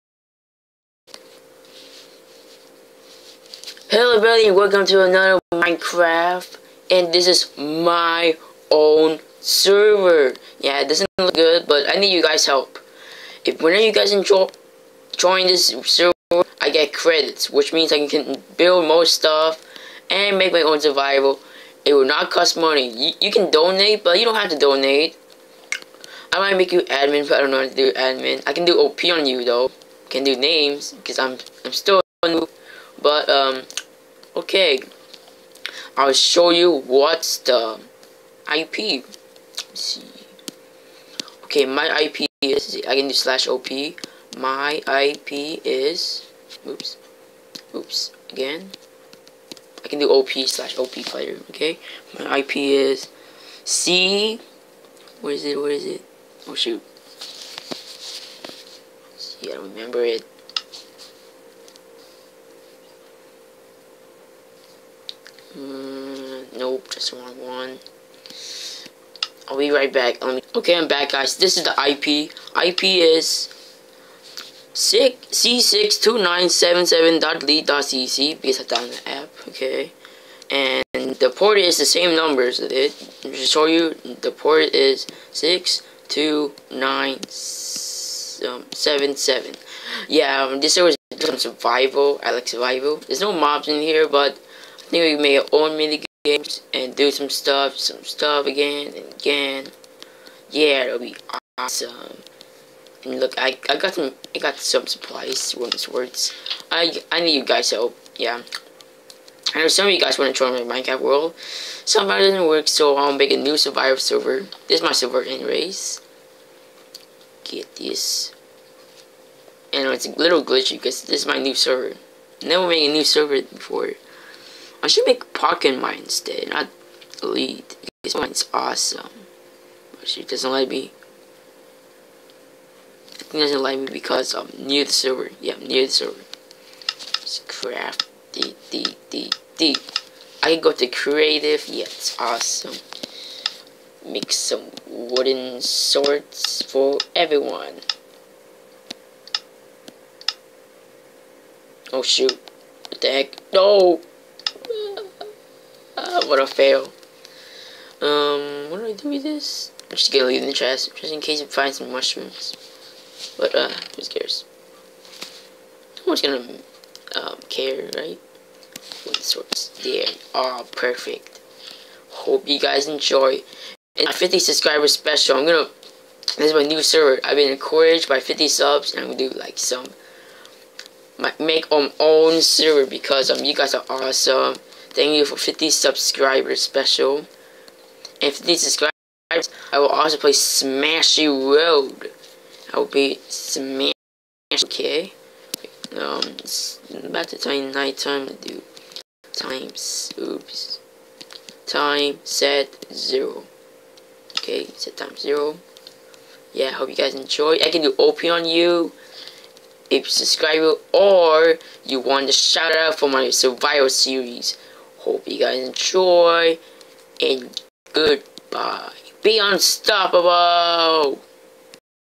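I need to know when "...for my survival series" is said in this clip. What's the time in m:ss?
3:32.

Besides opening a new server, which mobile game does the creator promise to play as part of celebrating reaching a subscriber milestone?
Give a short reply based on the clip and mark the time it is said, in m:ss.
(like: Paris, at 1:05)
Smashy Road, at 3:10.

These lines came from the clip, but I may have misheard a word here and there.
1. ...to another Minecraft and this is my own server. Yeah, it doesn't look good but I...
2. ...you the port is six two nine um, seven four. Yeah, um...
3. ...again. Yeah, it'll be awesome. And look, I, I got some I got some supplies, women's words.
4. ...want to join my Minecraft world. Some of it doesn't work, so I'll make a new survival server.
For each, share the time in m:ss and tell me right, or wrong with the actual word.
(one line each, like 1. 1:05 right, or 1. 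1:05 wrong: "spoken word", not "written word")
1. 0:04 right
2. 1:23 wrong: "seven", not "four"
3. 1:39 right
4. 1:50 right.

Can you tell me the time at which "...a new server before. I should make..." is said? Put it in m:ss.
2:02.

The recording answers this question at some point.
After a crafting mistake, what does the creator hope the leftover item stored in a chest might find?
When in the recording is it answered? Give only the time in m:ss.
2:41.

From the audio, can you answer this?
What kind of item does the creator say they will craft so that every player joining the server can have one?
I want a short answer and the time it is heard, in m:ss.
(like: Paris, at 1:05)
Wooden swords, at 2:24.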